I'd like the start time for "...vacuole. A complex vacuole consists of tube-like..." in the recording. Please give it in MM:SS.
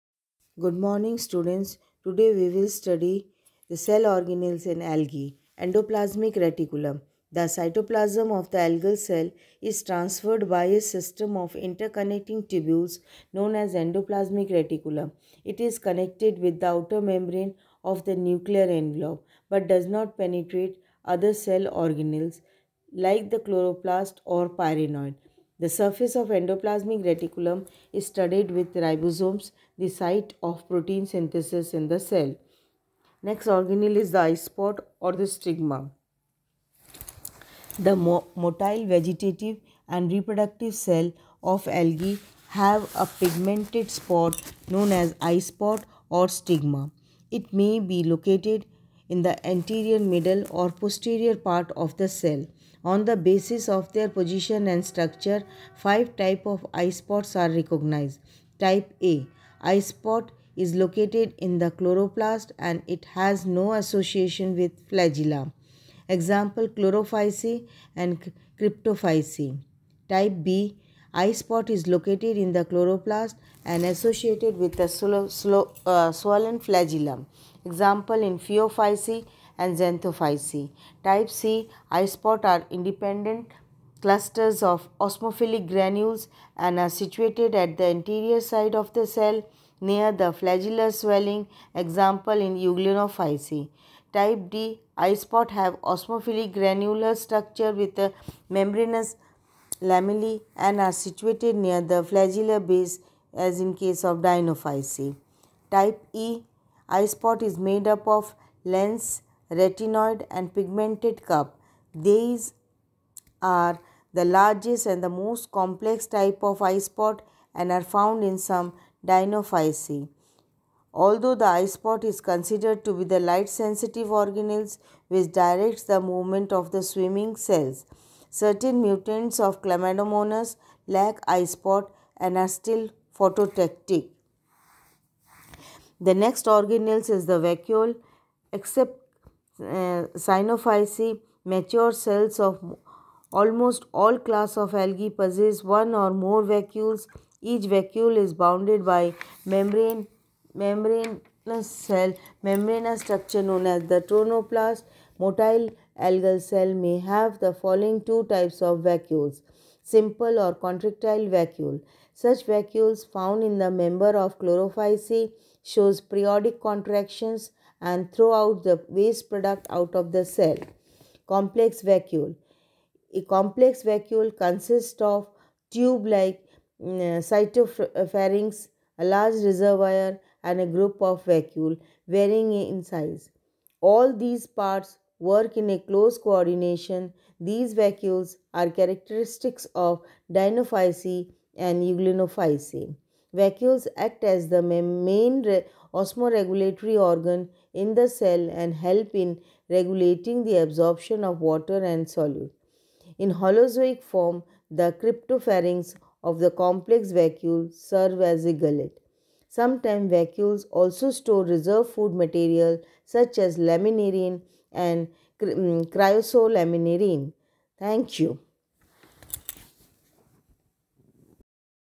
02:51.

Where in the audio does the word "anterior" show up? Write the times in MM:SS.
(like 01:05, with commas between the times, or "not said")
00:49, 01:27.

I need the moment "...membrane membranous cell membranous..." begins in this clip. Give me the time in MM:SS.
02:29.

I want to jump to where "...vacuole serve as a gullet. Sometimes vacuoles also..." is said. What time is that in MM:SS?
03:27.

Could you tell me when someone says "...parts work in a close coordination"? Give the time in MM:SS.
03:04.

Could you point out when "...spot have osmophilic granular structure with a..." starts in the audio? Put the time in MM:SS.
01:35.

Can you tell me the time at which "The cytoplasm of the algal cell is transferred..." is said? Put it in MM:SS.
00:07.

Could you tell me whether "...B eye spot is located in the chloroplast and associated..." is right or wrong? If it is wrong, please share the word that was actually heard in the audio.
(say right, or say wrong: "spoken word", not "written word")
right.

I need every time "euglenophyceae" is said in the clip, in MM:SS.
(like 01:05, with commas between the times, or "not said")
01:32, 03:11.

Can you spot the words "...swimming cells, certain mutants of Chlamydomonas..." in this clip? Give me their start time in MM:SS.
02:06.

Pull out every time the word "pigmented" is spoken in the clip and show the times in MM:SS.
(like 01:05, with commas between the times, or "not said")
00:43, 01:50.